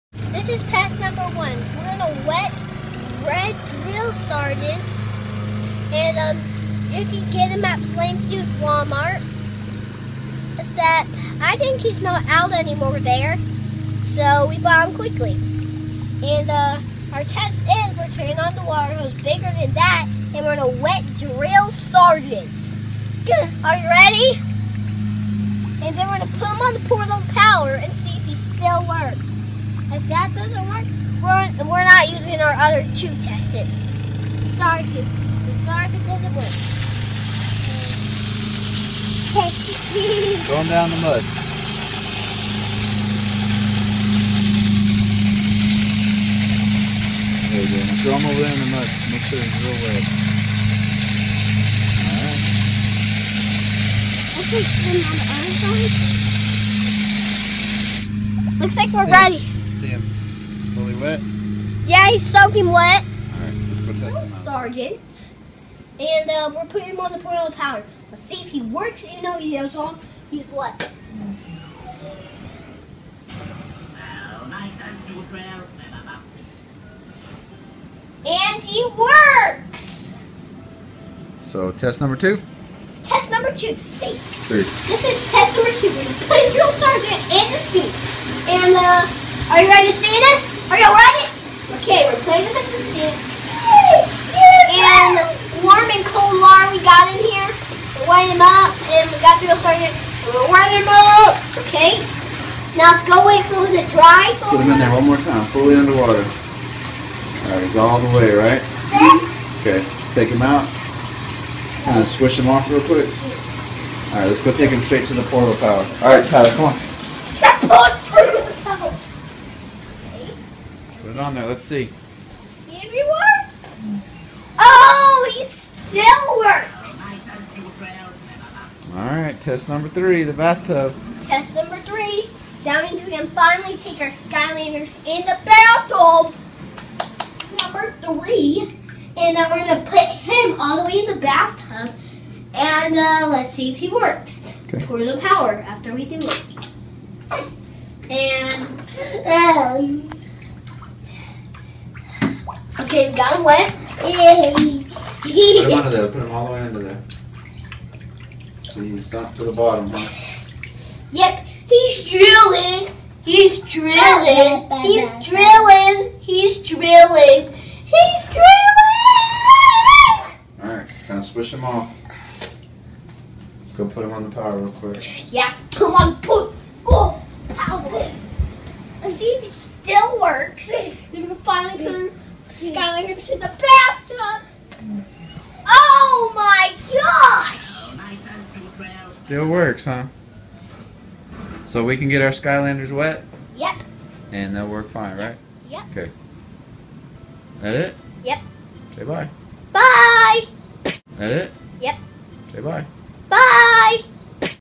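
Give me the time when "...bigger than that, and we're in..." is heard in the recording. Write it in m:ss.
0:19.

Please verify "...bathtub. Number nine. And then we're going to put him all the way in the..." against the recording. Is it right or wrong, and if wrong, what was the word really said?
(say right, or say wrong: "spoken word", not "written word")
wrong: "three", not "nine".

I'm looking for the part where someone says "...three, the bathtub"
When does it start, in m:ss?
2:09.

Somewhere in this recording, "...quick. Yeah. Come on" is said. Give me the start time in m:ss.
2:54.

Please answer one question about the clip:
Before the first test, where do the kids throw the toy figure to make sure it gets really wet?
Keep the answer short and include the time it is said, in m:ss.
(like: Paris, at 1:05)
In the mud, at 0:48.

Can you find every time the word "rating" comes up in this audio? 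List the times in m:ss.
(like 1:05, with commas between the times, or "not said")
not said.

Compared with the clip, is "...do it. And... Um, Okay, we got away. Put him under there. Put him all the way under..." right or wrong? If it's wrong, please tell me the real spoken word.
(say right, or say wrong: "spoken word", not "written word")
right.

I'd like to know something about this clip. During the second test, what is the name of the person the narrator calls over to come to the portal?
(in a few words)
Tyler.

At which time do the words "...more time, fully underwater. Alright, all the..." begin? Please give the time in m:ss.
1:45.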